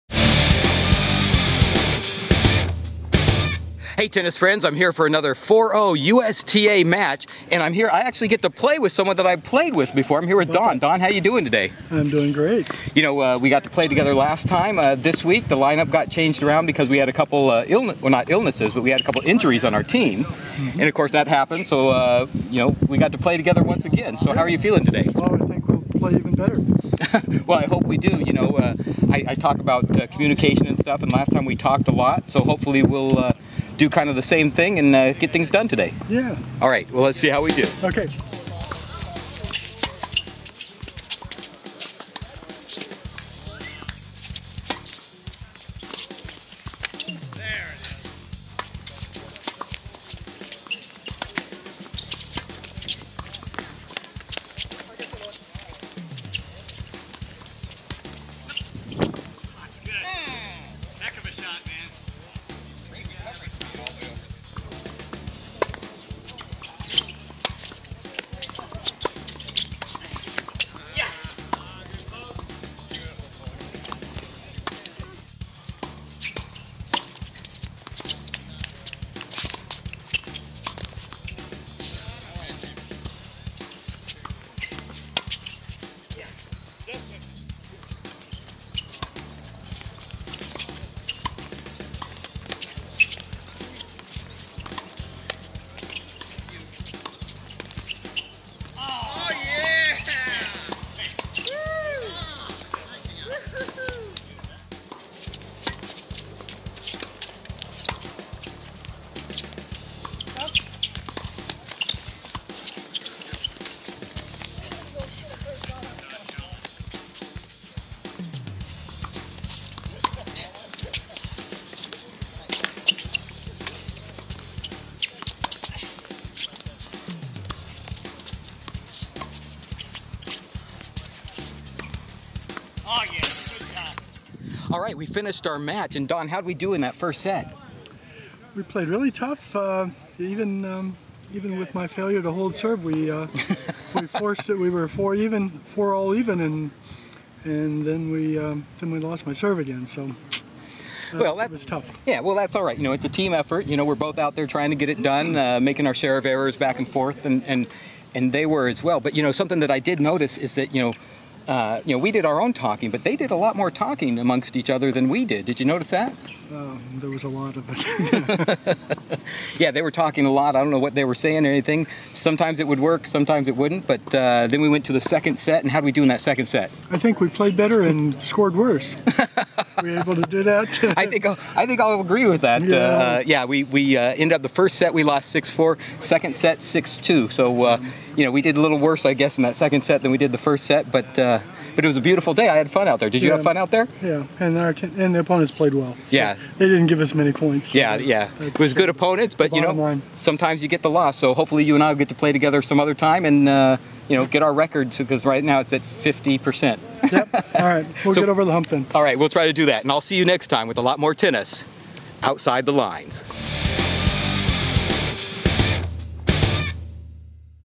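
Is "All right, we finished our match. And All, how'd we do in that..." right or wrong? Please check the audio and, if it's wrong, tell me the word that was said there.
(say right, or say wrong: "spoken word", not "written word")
wrong: "Don", not "All".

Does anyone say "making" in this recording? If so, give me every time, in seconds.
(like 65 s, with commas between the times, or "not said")
155 s.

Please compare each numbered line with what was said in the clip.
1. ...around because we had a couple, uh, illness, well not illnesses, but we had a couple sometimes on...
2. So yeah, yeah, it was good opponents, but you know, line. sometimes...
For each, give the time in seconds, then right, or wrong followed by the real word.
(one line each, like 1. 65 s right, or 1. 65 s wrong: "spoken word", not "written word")
1. 16 s wrong: "injuries", not "sometimes"
2. 197 s right.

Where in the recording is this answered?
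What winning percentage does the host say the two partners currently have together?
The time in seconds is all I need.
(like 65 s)
205 s.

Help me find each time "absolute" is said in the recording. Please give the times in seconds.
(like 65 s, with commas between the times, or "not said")
not said.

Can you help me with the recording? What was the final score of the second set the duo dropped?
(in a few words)
6-2.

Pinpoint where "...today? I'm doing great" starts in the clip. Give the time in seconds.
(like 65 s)
11 s.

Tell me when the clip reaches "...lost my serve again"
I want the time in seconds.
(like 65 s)
148 s.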